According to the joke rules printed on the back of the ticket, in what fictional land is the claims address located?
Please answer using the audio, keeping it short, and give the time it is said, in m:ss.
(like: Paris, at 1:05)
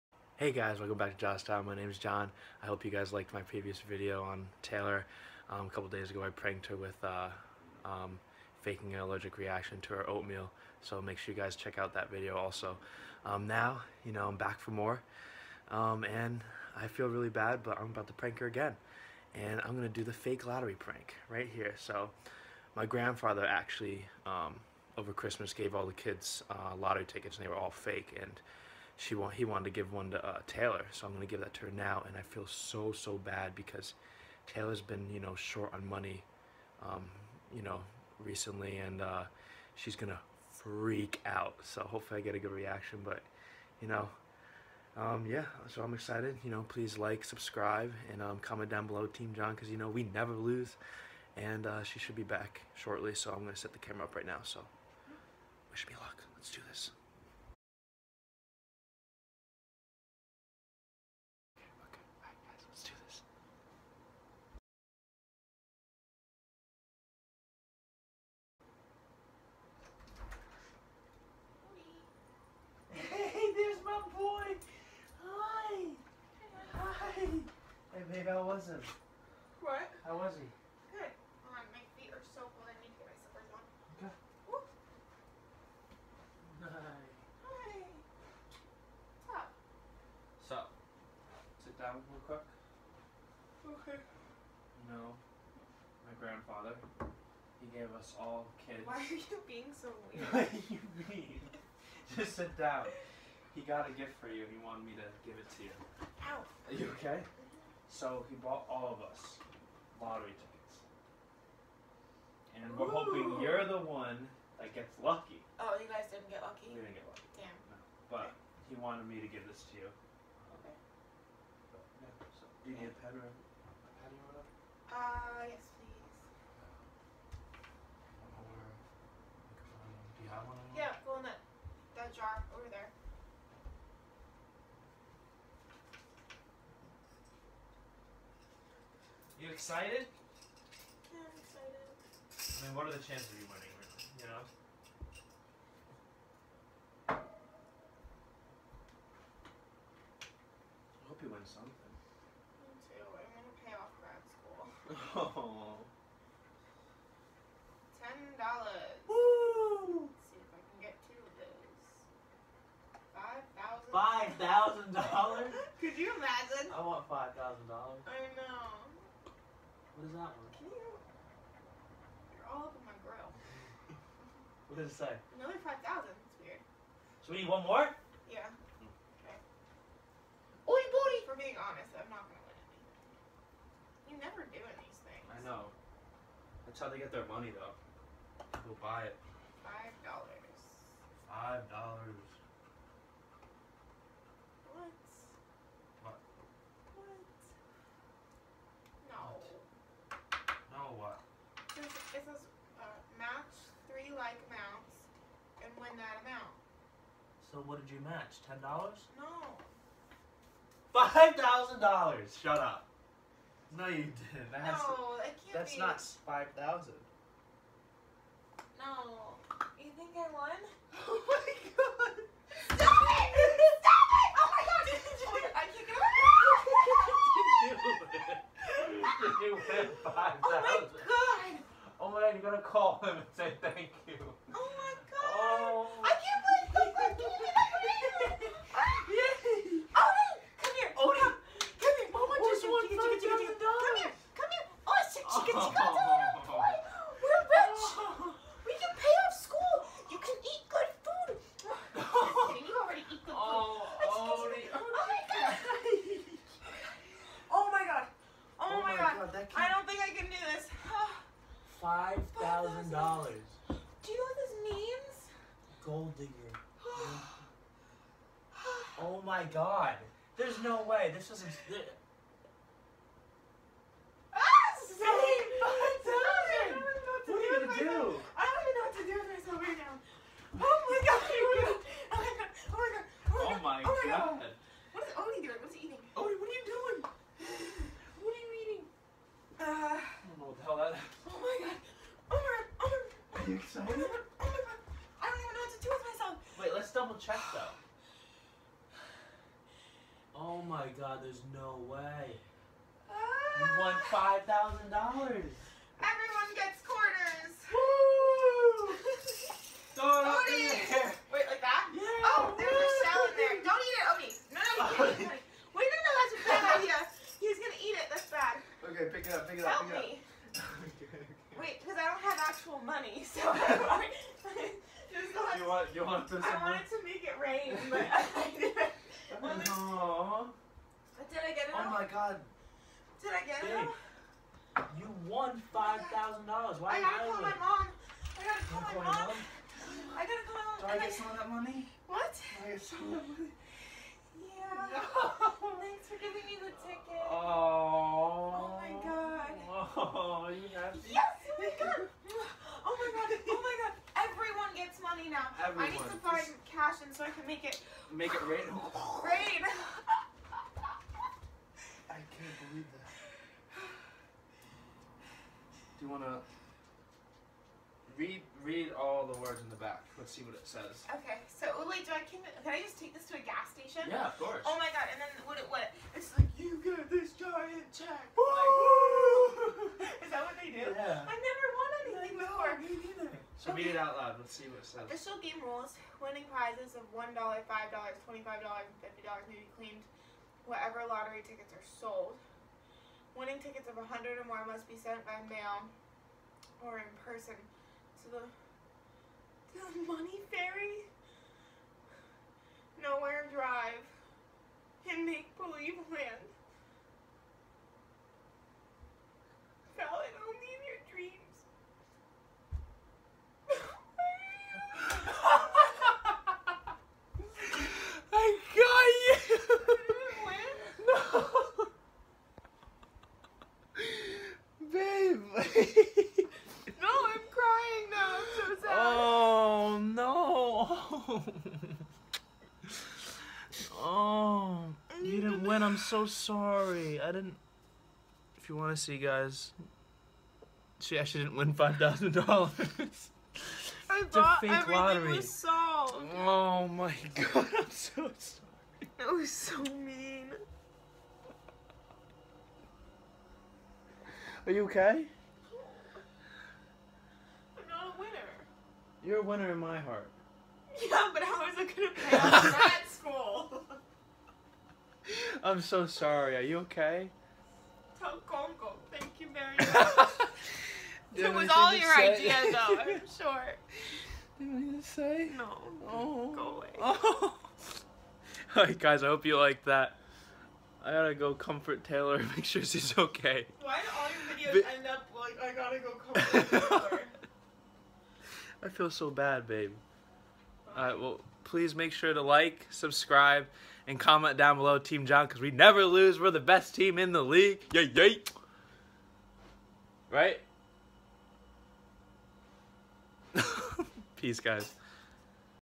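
Make Believe Land, at 6:45.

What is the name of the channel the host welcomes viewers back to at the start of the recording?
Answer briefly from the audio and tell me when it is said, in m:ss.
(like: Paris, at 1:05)
JOT Us Down, at 0:01.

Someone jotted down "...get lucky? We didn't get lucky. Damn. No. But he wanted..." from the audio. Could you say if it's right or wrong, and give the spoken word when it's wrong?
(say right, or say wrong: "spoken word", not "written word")
right.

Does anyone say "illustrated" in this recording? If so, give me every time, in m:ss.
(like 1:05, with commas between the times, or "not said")
not said.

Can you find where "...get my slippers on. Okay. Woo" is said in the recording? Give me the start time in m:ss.
1:22.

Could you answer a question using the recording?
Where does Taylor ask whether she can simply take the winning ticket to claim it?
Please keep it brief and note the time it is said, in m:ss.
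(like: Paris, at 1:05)
a gas station, at 6:13.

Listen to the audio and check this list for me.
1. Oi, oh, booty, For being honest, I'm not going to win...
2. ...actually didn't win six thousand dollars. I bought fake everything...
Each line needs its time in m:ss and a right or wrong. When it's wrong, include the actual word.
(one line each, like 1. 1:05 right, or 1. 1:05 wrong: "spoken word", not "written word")
1. 3:00 right
2. 7:21 wrong: "five", not "six".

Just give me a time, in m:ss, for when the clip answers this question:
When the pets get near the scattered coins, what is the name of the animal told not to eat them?
5:14.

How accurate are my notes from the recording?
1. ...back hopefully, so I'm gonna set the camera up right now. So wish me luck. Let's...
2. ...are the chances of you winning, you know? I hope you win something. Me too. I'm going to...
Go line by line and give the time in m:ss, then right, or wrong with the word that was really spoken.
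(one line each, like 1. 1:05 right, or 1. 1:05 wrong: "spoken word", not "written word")
1. 0:52 wrong: "shortly", not "hopefully"
2. 2:22 right.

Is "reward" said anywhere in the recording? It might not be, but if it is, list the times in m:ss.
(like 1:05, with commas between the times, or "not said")
not said.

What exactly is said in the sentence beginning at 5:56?
cash, and so I can make it make it rain.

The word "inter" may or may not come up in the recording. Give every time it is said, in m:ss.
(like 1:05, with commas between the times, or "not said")
not said.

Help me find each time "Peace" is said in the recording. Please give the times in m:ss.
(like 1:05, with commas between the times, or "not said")
8:24.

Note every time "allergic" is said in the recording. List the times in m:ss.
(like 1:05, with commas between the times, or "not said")
0:09.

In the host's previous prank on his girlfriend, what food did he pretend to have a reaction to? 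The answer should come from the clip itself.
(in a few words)
oatmeal.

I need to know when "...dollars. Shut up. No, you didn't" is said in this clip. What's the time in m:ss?
3:31.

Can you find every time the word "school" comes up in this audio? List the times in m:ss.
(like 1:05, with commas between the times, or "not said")
2:34, 7:43.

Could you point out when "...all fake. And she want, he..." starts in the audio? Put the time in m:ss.
0:27.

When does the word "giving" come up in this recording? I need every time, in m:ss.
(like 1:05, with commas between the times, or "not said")
5:46.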